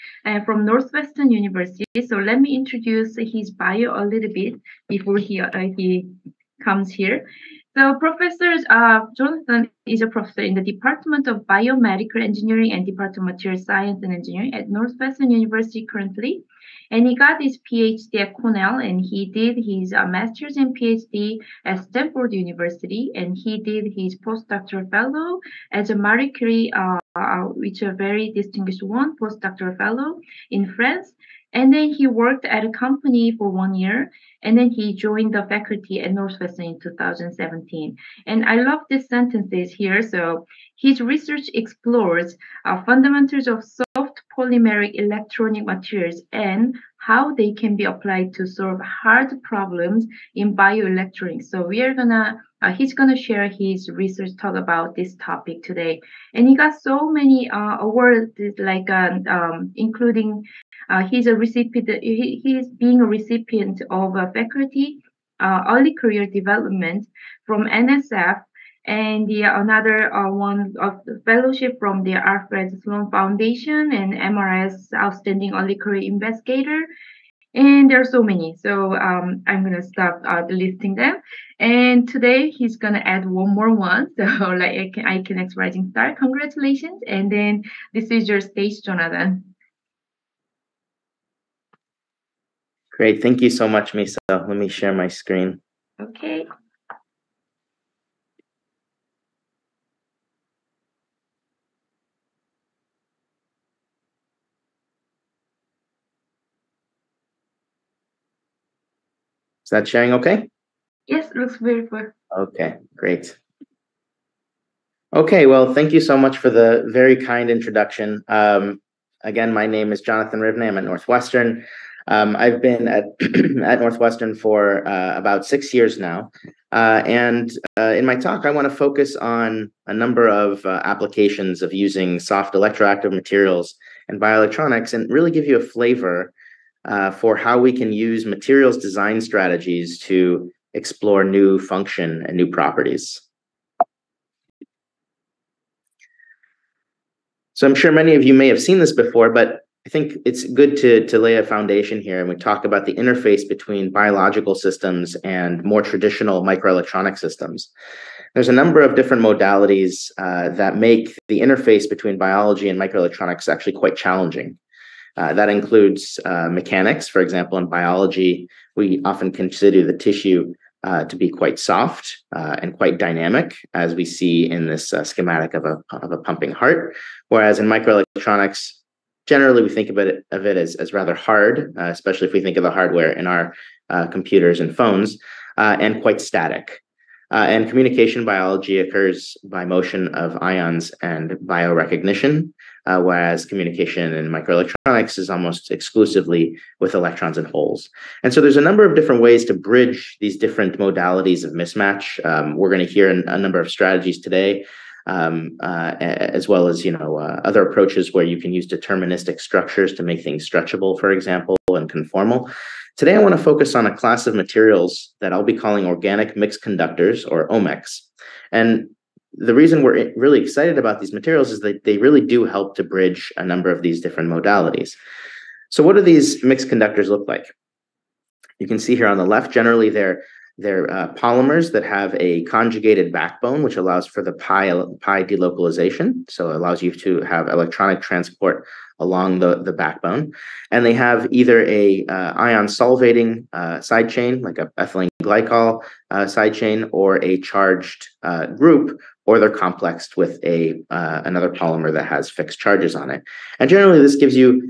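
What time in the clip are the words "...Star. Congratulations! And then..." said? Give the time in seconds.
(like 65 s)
85 s.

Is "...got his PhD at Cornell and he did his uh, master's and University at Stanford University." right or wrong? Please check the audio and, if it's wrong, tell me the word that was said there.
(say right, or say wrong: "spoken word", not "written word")
wrong: "PhD", not "University".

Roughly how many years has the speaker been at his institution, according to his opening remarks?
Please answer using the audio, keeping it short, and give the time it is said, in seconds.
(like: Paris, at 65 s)
6, at 125 s.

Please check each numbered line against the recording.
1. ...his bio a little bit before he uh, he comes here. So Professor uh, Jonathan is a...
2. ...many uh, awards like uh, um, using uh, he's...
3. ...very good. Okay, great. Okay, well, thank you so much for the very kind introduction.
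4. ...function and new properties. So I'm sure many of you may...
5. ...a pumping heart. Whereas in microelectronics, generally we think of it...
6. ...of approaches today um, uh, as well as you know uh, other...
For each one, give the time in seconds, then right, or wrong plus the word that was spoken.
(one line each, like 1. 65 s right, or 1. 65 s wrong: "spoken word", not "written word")
1. 3 s right
2. 57 s wrong: "including", not "using"
3. 111 s right
4. 141 s right
5. 176 s right
6. 203 s wrong: "strategies", not "approaches".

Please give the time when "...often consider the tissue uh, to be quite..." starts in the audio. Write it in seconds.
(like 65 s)
169 s.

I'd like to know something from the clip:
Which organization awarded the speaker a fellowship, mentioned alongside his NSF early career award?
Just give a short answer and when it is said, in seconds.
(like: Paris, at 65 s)
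Alfred Sloan Foundation, at 72 s.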